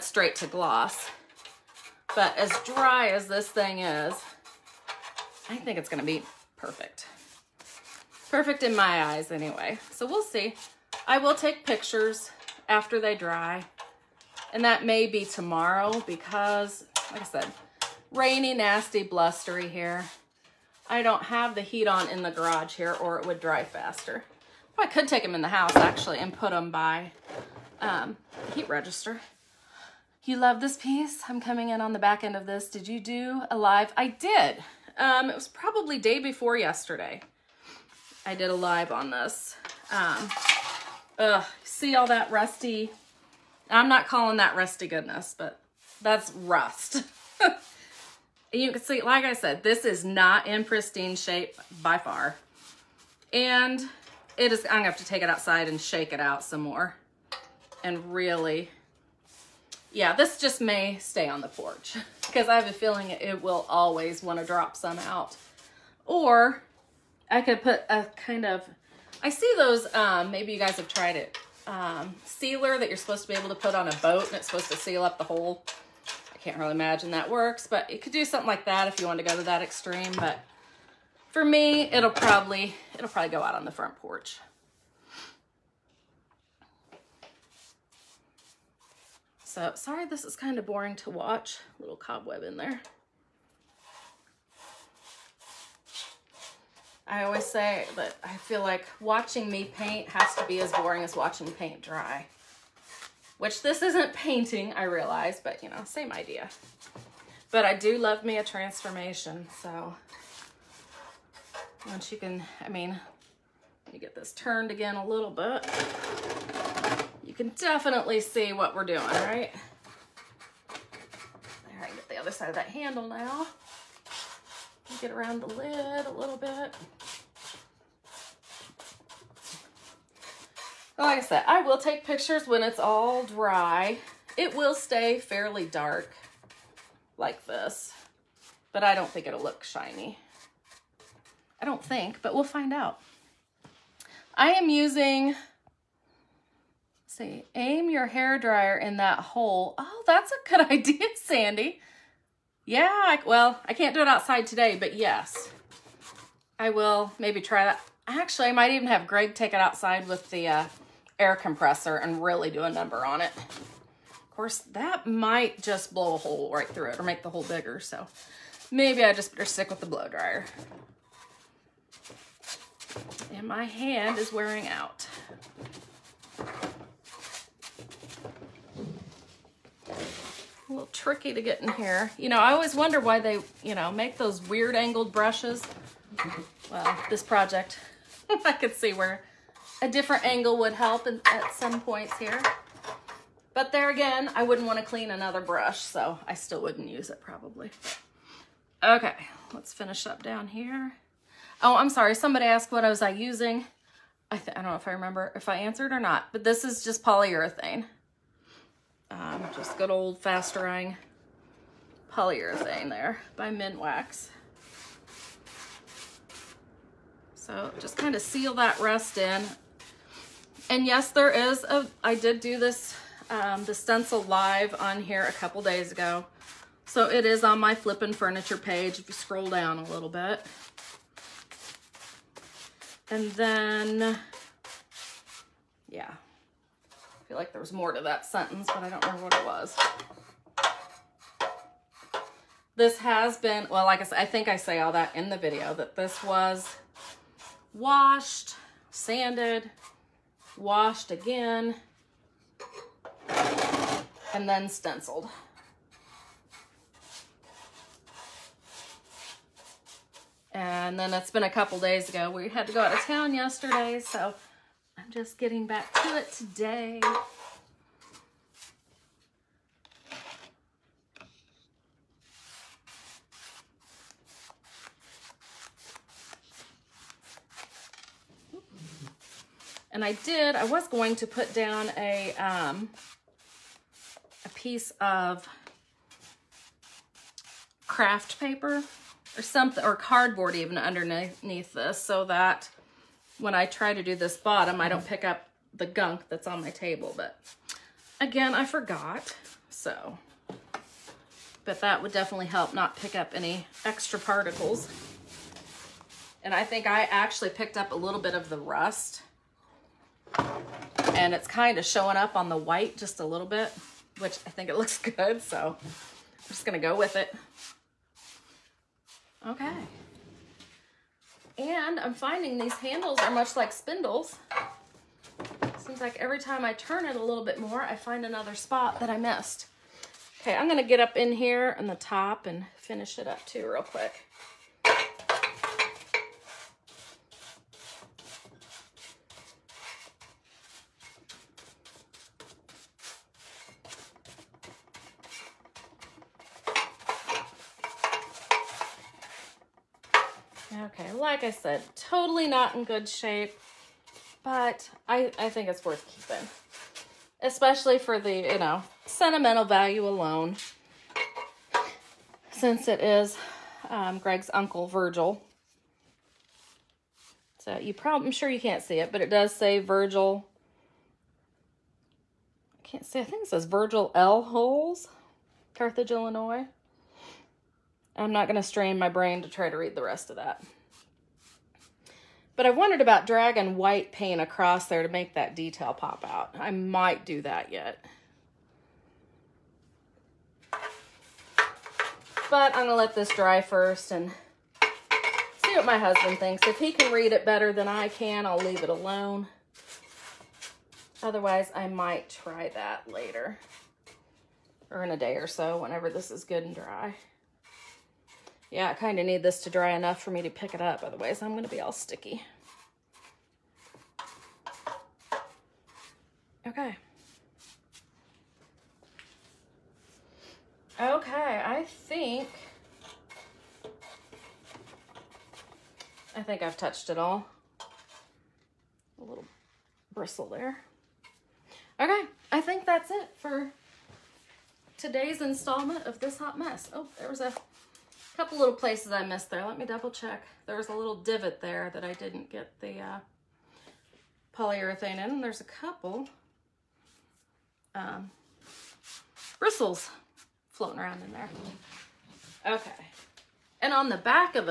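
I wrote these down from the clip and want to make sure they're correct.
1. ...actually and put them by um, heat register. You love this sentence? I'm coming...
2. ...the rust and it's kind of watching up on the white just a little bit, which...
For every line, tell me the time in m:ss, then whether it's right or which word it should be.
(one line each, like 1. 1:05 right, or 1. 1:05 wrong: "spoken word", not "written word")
1. 0:25 wrong: "piece", not "sentence"
2. 5:08 wrong: "showing", not "watching".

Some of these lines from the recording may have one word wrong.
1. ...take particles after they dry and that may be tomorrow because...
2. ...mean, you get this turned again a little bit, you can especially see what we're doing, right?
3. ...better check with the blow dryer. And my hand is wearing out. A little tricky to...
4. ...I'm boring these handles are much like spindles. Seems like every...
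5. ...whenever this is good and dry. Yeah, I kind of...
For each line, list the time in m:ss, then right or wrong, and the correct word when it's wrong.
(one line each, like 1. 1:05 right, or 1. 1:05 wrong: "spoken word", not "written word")
1. 0:11 wrong: "pictures", not "particles"
2. 1:52 wrong: "definitely", not "especially"
3. 2:49 wrong: "stick", not "check"
4. 5:21 wrong: "finding", not "boring"
5. 6:45 right.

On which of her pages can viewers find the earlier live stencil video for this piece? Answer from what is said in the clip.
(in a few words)
Flippin Furniture.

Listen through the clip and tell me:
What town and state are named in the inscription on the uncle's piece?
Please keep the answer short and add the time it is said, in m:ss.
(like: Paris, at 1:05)
Carthage, Illinois, at 6:15.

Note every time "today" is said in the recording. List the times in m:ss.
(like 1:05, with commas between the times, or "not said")
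2:34, 4:26, 7:14.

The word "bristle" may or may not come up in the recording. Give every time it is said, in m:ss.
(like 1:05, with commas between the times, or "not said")
7:10, 7:29.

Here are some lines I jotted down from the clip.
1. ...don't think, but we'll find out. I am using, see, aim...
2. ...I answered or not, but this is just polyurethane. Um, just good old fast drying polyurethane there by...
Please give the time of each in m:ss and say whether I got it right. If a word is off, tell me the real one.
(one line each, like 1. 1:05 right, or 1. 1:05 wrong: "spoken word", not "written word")
1. 2:21 right
2. 3:25 right.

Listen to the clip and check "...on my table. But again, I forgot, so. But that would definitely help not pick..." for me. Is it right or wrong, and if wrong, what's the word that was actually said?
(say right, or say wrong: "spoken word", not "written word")
right.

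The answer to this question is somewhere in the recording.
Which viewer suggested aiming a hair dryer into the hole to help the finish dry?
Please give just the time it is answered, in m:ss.
2:31.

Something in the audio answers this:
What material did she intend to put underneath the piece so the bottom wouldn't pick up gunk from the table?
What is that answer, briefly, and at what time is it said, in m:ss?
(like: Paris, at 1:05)
craft paper, at 4:47.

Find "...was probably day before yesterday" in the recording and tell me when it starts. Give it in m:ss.
0:35.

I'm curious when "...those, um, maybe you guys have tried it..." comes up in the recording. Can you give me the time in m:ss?
1:09.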